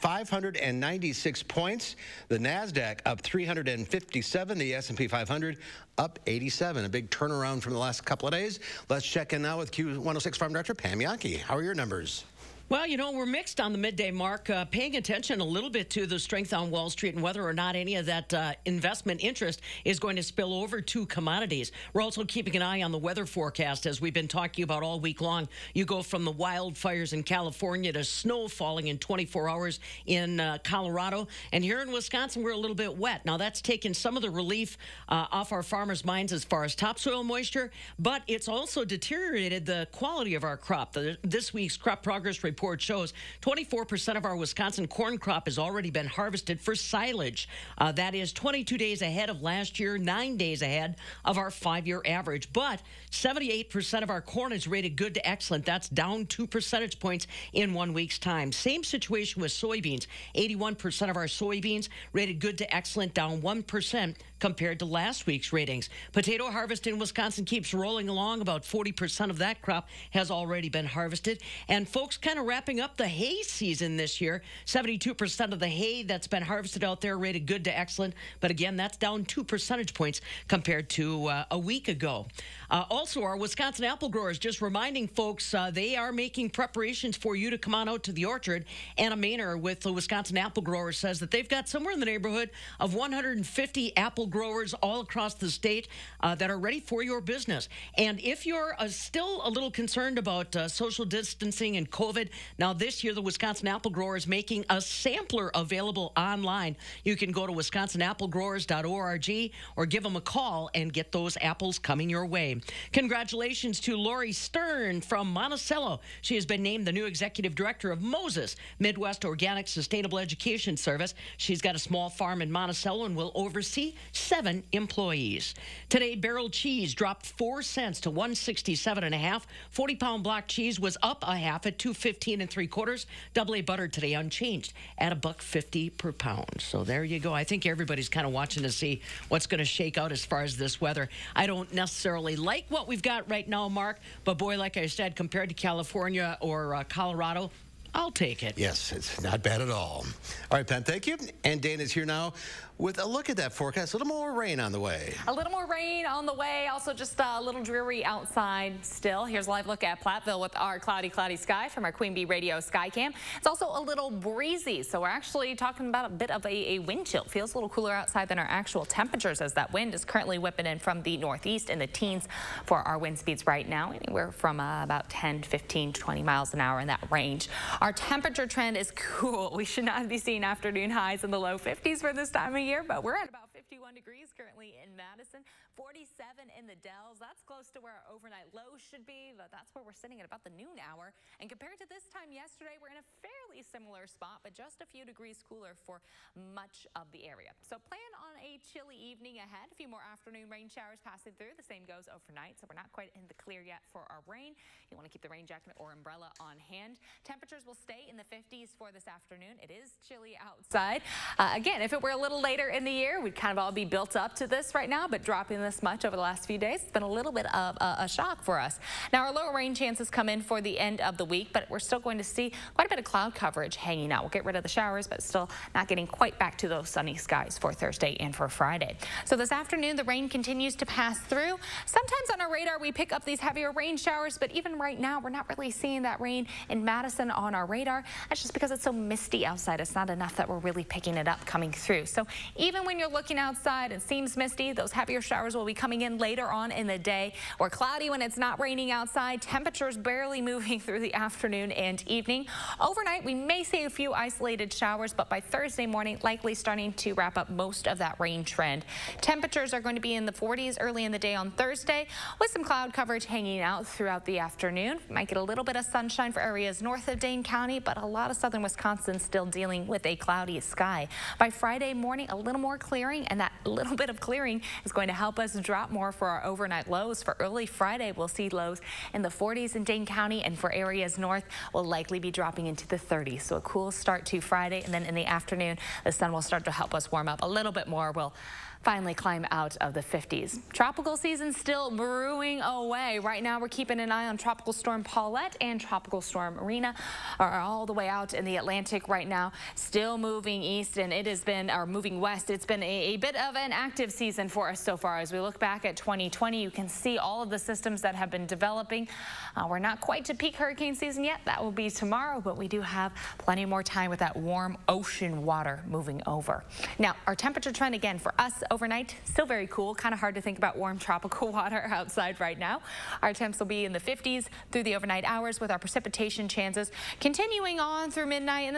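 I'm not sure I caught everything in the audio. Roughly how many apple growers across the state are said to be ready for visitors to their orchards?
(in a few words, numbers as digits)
150.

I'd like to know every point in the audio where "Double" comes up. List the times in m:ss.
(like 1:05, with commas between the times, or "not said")
2:13.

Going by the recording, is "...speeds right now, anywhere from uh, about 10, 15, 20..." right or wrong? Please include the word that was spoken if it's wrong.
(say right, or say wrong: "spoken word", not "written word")
right.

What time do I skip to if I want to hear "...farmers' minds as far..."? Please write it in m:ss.
0:35.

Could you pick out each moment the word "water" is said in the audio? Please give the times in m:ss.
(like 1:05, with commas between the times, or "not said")
5:15, 5:21.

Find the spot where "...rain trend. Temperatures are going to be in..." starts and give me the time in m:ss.
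4:18.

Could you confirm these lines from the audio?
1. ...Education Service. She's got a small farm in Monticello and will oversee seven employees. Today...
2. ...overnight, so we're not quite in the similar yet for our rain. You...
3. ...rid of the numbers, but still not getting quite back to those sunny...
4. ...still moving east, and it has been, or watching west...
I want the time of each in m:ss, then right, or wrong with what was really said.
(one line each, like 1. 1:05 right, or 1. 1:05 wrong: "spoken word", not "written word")
1. 2:00 right
2. 3:22 wrong: "clear", not "similar"
3. 3:44 wrong: "showers", not "numbers"
4. 4:59 wrong: "moving", not "watching".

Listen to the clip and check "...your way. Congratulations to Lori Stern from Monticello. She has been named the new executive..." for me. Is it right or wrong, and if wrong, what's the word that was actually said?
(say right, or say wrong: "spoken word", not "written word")
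right.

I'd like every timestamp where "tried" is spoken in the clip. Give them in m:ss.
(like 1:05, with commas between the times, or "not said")
not said.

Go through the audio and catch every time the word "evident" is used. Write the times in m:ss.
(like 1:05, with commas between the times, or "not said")
not said.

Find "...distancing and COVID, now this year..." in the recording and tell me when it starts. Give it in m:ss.
1:41.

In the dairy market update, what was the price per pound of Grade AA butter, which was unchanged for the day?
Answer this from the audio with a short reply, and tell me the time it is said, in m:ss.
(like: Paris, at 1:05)
$1.50, at 2:15.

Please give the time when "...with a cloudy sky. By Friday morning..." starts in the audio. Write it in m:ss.
4:29.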